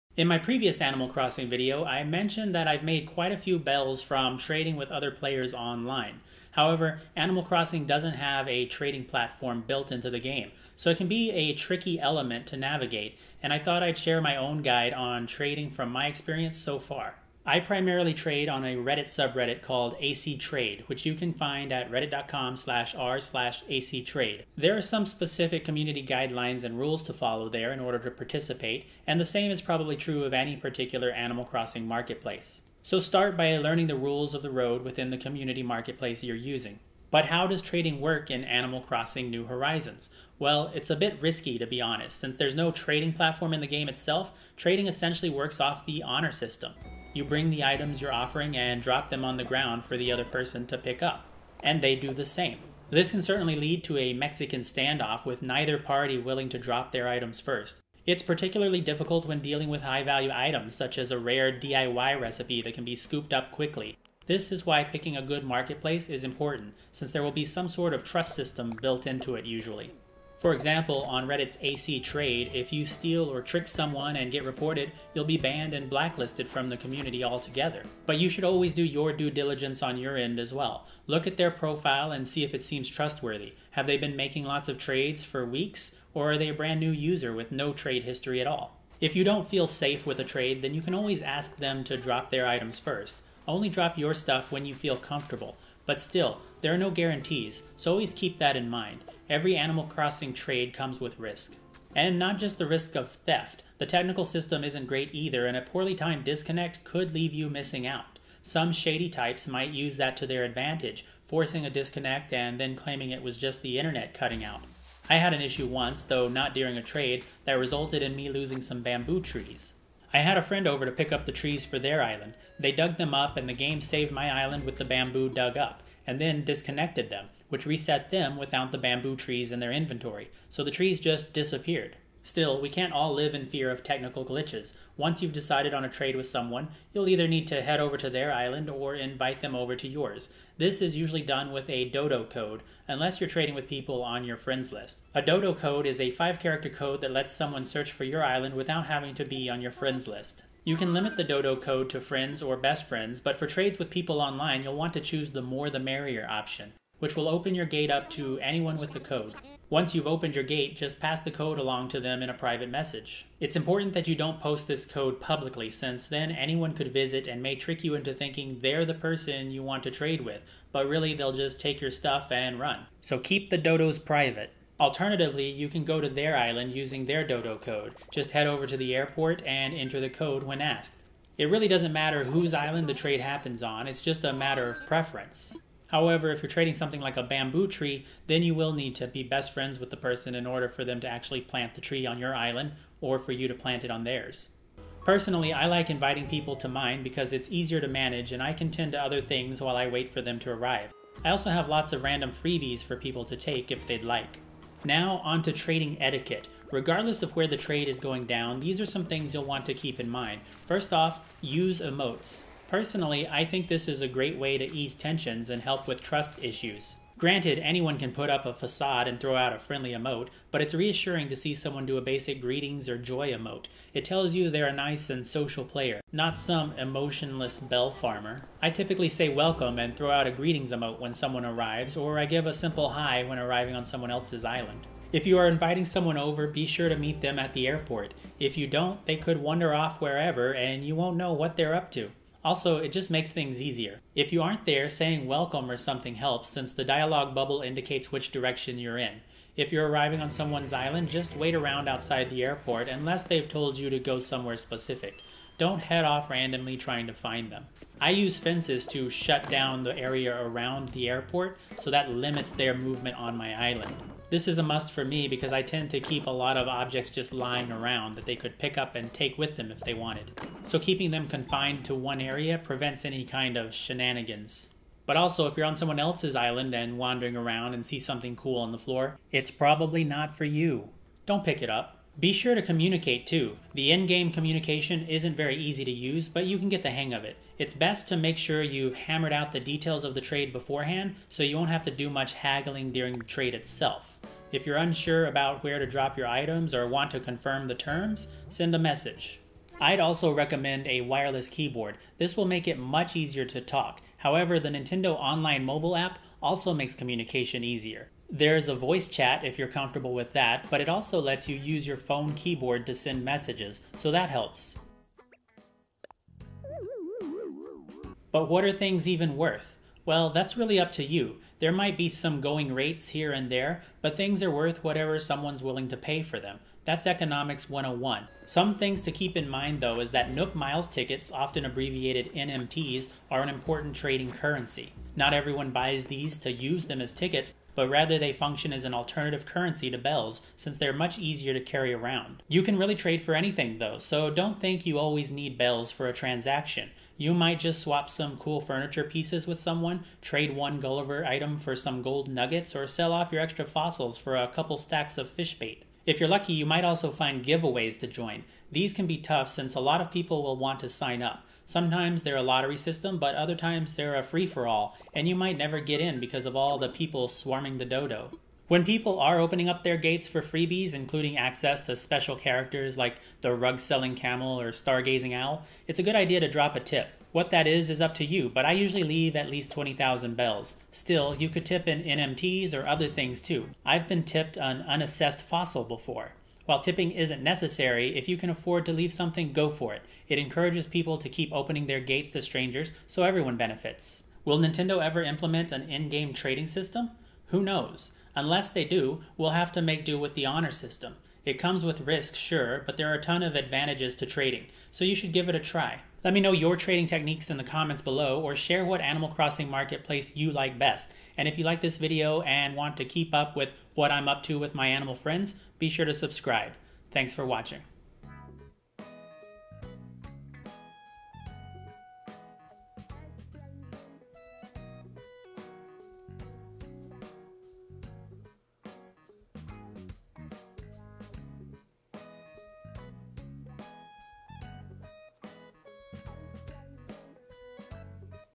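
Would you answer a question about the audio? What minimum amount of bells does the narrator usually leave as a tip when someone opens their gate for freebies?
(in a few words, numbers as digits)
20,000 bells.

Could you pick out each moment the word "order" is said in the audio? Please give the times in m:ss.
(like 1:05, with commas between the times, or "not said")
0:27, 3:10.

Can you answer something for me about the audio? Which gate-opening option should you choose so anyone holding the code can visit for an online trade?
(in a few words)
More the merrier.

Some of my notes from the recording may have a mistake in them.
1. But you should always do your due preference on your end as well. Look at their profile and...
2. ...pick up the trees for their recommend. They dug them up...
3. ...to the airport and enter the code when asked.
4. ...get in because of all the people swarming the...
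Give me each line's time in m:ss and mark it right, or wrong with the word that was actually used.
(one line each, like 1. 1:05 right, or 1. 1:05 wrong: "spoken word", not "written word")
1. 1:18 wrong: "diligence", not "preference"
2. 2:00 wrong: "island", not "recommend"
3. 2:58 right
4. 6:05 right.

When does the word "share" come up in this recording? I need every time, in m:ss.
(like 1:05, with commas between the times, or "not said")
0:13, 6:48.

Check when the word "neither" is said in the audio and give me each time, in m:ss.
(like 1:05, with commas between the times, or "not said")
0:55.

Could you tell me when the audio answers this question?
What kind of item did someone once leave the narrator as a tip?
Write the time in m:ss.
6:24.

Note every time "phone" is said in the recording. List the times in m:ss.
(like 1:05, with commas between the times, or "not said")
5:11.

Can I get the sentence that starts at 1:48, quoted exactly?
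Some shady types might use that to their advantage, forcing a disconnect and then claiming it was just the internet cutting out.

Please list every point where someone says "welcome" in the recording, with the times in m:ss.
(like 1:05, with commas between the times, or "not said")
3:49, 4:05.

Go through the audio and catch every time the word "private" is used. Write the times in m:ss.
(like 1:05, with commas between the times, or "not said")
2:42, 2:53.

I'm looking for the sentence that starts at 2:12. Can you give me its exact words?
Still, we can't all live in fear of technical glitches.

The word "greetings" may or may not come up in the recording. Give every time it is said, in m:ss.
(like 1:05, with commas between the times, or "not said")
3:42, 3:50.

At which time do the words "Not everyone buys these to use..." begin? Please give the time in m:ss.
5:35.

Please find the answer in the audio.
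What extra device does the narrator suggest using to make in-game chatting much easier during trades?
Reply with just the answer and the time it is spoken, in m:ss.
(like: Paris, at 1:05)
Wireless keyboard, at 5:00.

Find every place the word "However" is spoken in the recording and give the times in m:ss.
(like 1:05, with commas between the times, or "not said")
0:06, 3:05, 5:04.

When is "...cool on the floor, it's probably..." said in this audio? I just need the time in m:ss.
4:38.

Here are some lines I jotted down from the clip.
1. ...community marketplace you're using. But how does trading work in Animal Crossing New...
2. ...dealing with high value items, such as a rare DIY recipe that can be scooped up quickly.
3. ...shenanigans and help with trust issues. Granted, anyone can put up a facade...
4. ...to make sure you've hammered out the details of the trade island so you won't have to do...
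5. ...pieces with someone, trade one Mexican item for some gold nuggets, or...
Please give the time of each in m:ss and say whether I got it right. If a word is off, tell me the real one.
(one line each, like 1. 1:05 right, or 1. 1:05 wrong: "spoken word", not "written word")
1. 0:35 right
2. 0:59 right
3. 3:34 wrong: "tensions", not "shenanigans"
4. 4:48 wrong: "beforehand", not "island"
5. 5:49 wrong: "Gulliver", not "Mexican".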